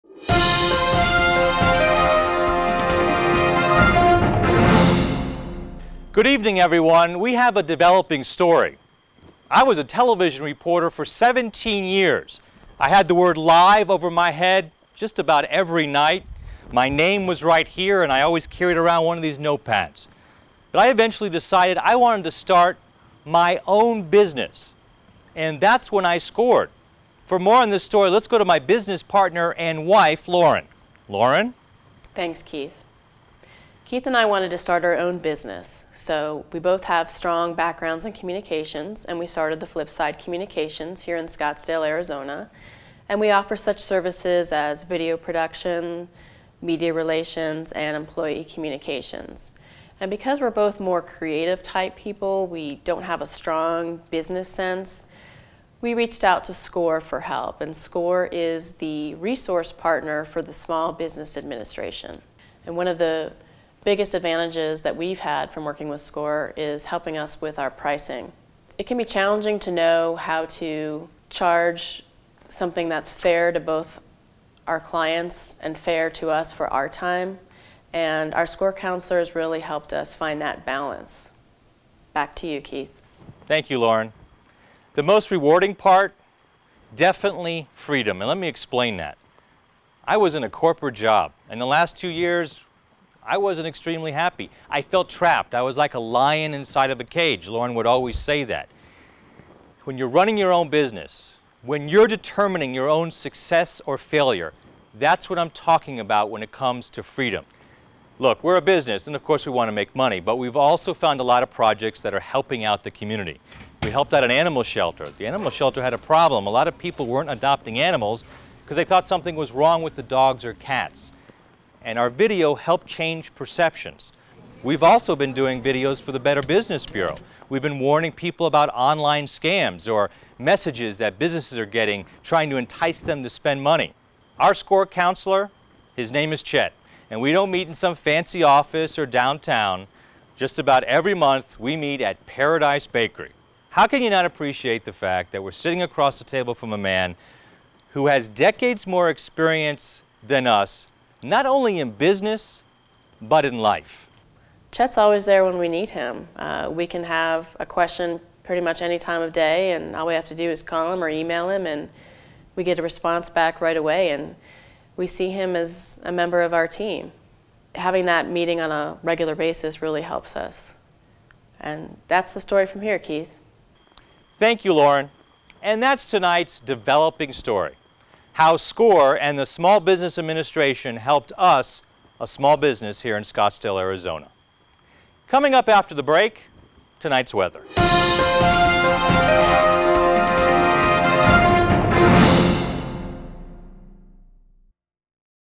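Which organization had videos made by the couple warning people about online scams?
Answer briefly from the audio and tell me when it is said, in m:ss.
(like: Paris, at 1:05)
Better Business Bureau, at 2:06.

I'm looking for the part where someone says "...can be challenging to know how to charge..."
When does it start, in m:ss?
1:08.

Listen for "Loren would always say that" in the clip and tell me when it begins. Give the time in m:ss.
1:37.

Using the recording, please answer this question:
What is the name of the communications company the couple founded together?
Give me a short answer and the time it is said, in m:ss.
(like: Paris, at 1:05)
Flip Side Communications, at 0:39.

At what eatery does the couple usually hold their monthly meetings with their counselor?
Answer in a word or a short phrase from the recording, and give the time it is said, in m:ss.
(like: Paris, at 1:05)
Paradise Bakery, at 2:22.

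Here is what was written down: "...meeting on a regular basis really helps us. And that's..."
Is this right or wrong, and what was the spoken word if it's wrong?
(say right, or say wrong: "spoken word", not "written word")
right.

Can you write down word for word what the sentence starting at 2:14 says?
Our score counselor, his name is Chet, and we don't meet in some fancy office or downtown.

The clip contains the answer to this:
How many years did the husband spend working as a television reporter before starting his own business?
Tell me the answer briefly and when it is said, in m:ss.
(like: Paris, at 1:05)
17, at 0:11.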